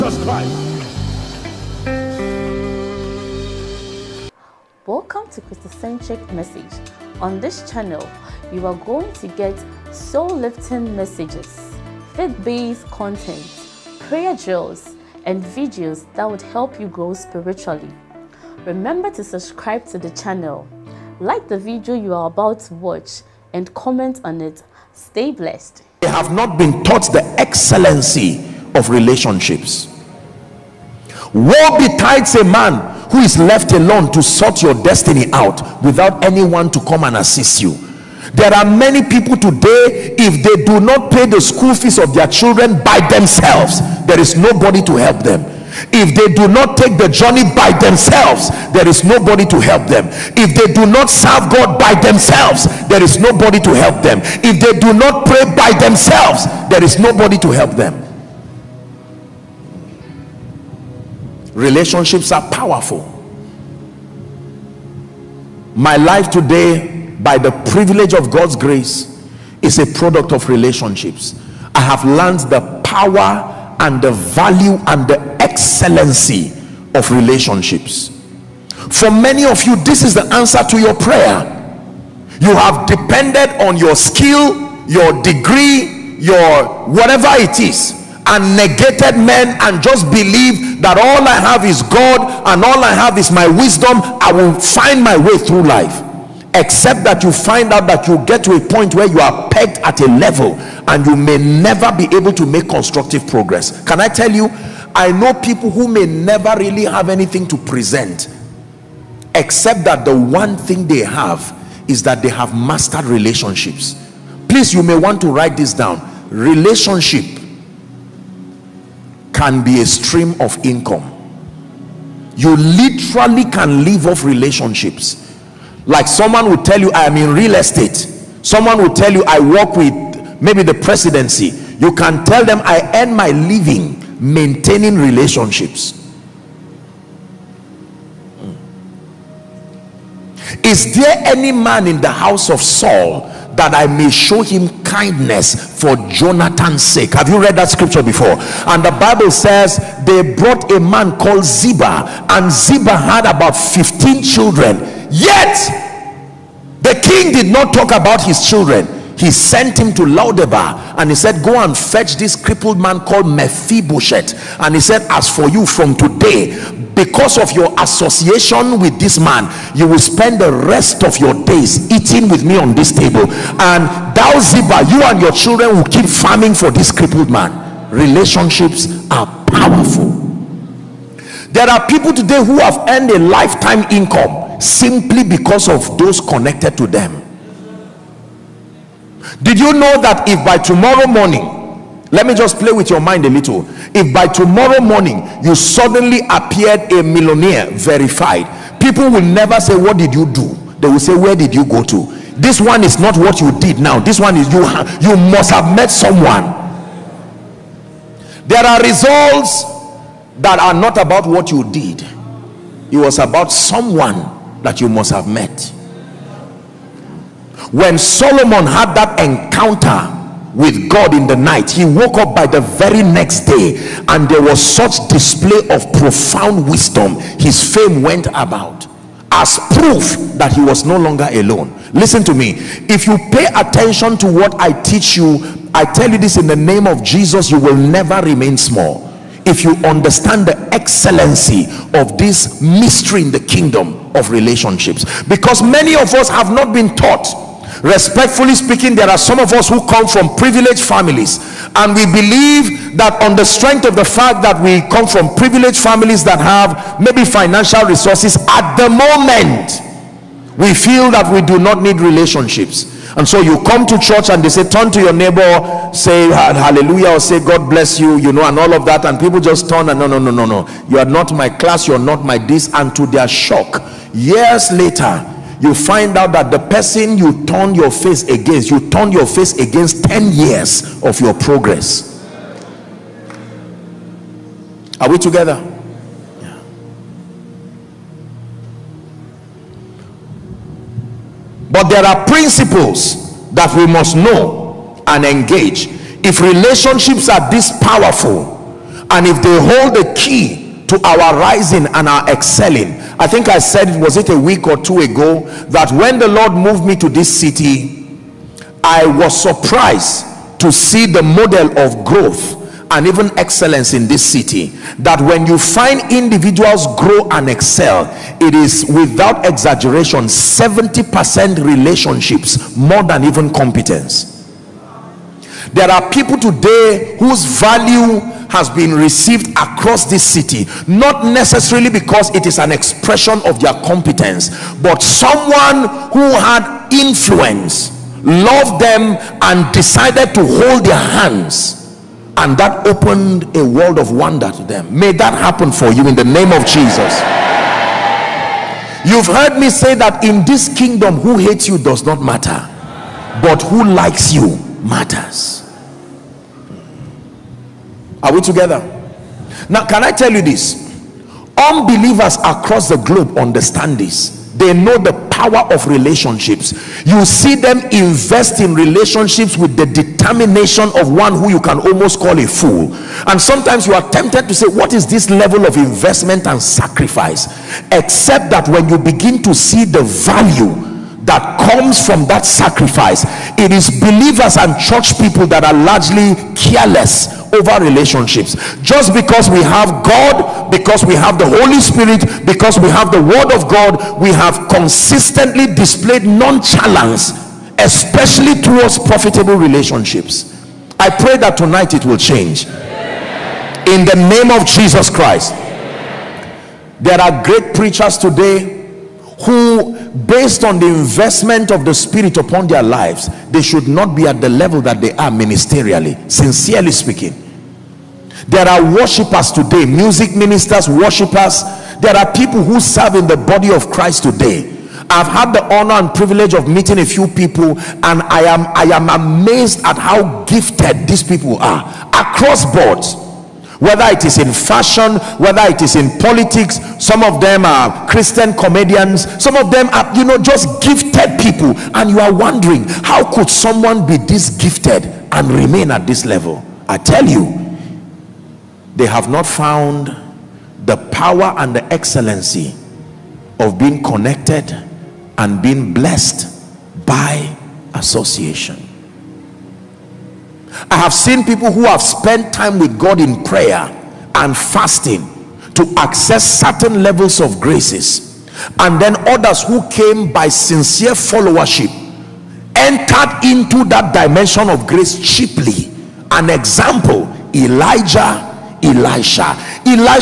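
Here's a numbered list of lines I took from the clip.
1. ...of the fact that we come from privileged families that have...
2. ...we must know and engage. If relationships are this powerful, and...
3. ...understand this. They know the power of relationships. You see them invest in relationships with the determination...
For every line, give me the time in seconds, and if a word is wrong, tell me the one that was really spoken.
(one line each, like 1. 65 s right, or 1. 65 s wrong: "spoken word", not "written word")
1. 253 s right
2. 293 s right
3. 363 s right.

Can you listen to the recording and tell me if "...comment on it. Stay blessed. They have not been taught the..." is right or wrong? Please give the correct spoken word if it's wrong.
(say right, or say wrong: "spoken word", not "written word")
right.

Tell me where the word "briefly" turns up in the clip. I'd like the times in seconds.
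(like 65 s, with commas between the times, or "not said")
not said.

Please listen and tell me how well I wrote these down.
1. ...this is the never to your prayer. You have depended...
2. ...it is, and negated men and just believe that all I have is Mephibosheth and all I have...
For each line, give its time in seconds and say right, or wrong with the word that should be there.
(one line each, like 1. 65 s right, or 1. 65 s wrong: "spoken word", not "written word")
1. 79 s wrong: "answer", not "never"
2. 87 s wrong: "God", not "Mephibosheth".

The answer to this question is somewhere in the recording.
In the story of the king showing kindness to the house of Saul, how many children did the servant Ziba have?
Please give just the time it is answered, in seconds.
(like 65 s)
153 s.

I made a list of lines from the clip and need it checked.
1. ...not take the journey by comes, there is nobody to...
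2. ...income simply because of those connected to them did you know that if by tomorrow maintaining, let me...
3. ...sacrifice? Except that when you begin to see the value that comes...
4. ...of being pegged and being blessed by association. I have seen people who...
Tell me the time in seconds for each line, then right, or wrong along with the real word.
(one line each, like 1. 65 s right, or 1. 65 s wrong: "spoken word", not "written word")
1. 46 s wrong: "themselves", not "comes"
2. 183 s wrong: "morning", not "maintaining"
3. 376 s right
4. 453 s wrong: "connected", not "pegged".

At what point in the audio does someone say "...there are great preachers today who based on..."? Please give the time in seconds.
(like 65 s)
406 s.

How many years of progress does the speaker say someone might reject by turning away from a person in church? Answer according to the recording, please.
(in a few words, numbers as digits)
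10 years.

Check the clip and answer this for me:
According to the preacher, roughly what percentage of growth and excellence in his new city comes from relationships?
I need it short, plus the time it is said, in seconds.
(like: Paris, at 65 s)
70 percent, at 320 s.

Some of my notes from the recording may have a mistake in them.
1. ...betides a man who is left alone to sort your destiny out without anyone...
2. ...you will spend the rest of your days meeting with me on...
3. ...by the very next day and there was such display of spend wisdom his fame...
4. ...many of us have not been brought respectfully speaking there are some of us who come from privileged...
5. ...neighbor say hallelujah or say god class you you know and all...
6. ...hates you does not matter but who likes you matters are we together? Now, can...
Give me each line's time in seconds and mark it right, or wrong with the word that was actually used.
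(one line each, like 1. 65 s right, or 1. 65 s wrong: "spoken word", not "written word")
1. 31 s right
2. 169 s wrong: "eating", not "meeting"
3. 222 s wrong: "profound", not "spend"
4. 245 s wrong: "taught", not "brought"
5. 265 s wrong: "bless", not "class"
6. 351 s right.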